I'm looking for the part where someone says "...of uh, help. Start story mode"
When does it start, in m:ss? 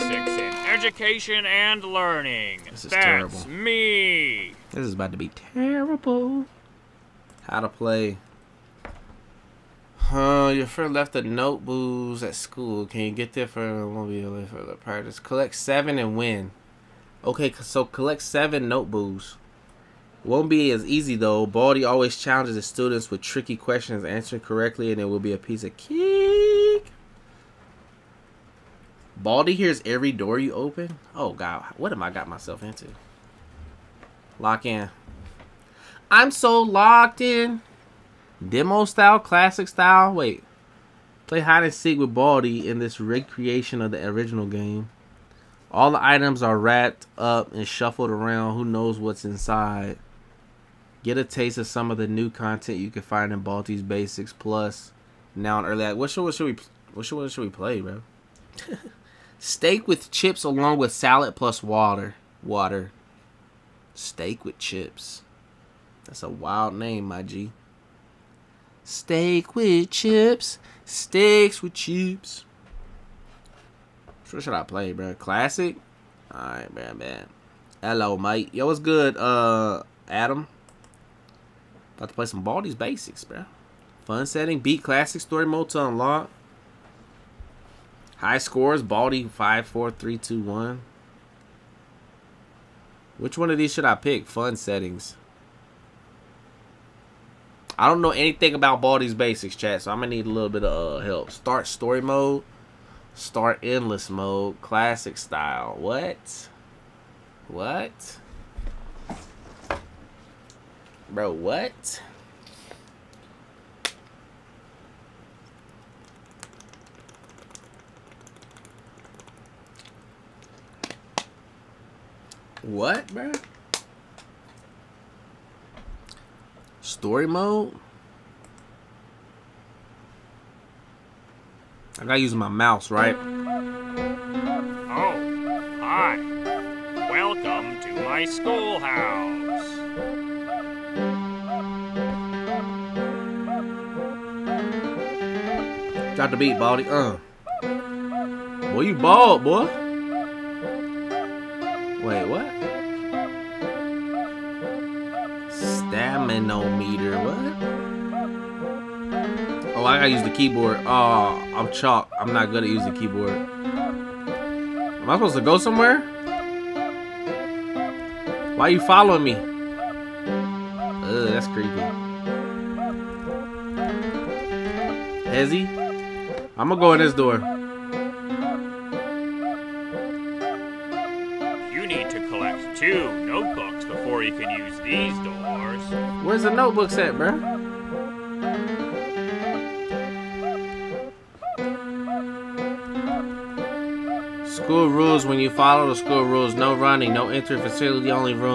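1:40.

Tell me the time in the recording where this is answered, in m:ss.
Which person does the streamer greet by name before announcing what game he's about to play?
1:20.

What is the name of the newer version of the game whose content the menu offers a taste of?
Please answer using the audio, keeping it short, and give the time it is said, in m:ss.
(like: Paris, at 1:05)
Baldi's Basics Plus, at 0:53.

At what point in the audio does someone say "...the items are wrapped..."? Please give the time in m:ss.
0:45.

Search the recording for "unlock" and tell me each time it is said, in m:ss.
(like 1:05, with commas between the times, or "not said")
1:25.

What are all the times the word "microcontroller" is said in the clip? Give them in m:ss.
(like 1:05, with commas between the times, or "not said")
not said.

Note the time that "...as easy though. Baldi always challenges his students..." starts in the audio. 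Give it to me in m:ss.
0:20.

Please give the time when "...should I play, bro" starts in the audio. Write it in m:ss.
1:14.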